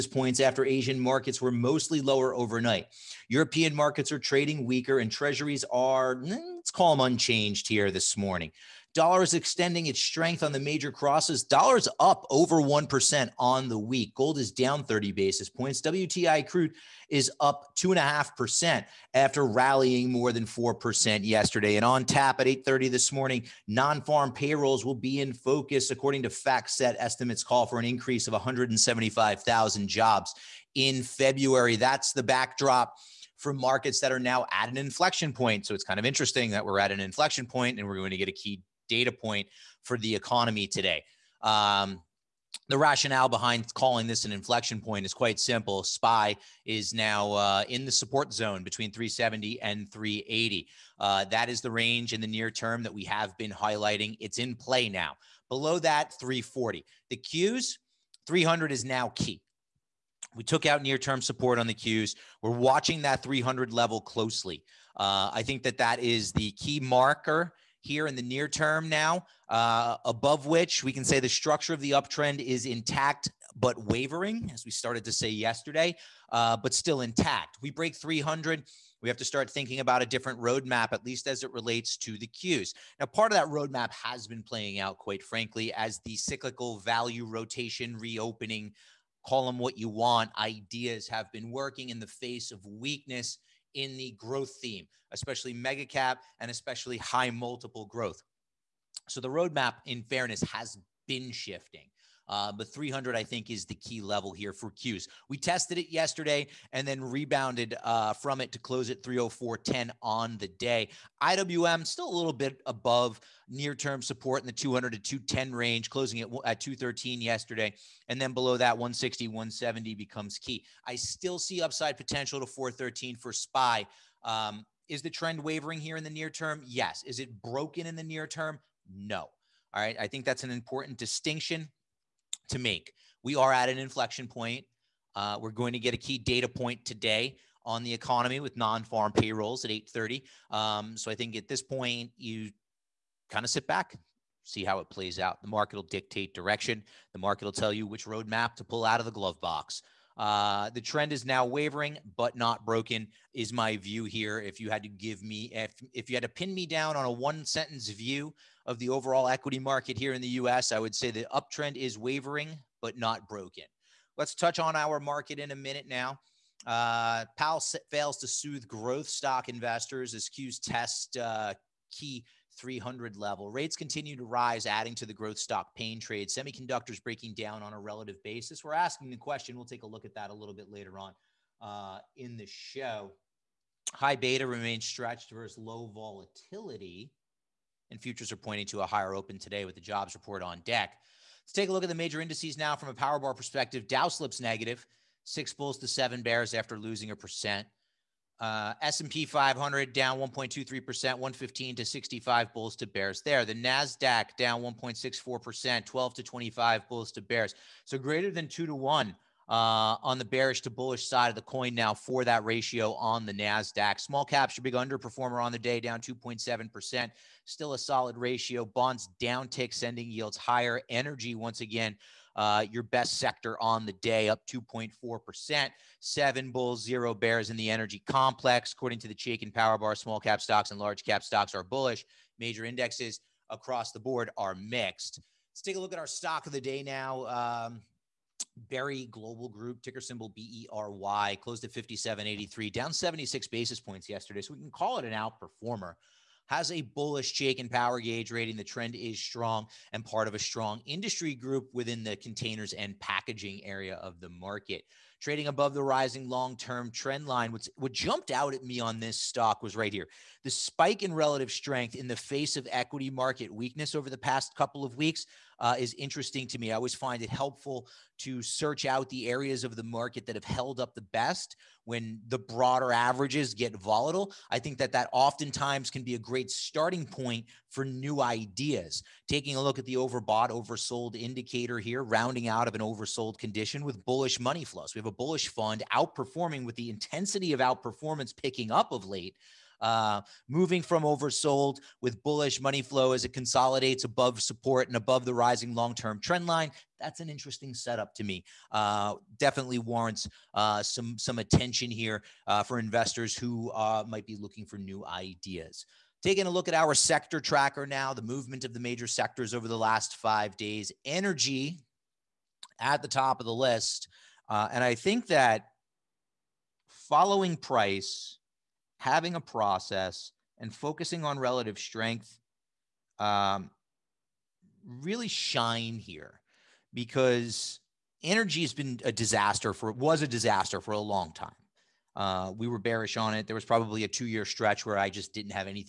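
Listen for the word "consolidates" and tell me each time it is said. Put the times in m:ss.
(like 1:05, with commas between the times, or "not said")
4:53.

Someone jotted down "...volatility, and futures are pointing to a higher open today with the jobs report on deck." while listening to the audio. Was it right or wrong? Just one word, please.
right.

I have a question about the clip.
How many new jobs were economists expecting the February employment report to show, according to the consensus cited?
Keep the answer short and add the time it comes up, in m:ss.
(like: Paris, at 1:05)
175,000, at 0:28.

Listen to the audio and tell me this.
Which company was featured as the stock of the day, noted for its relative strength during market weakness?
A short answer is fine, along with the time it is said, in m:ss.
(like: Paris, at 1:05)
Berry Global Group, at 3:58.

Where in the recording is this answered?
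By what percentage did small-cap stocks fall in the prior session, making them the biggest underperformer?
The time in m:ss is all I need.
3:36.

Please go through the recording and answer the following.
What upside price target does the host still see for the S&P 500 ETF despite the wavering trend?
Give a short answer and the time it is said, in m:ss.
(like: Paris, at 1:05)
413, at 2:02.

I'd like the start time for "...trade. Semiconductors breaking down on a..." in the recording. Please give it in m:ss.
2:55.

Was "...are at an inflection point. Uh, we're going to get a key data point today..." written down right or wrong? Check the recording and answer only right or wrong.
right.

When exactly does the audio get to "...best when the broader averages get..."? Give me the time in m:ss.
4:31.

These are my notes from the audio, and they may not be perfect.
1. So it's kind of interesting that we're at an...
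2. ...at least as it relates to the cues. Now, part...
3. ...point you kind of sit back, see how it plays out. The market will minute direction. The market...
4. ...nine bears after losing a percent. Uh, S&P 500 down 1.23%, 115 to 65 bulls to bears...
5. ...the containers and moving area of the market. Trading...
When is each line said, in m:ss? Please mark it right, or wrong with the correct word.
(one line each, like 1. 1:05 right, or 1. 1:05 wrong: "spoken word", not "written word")
1. 0:35 right
2. 1:20 right
3. 2:21 wrong: "dictate", not "minute"
4. 3:15 wrong: "seven", not "nine"
5. 4:12 wrong: "packaging", not "moving".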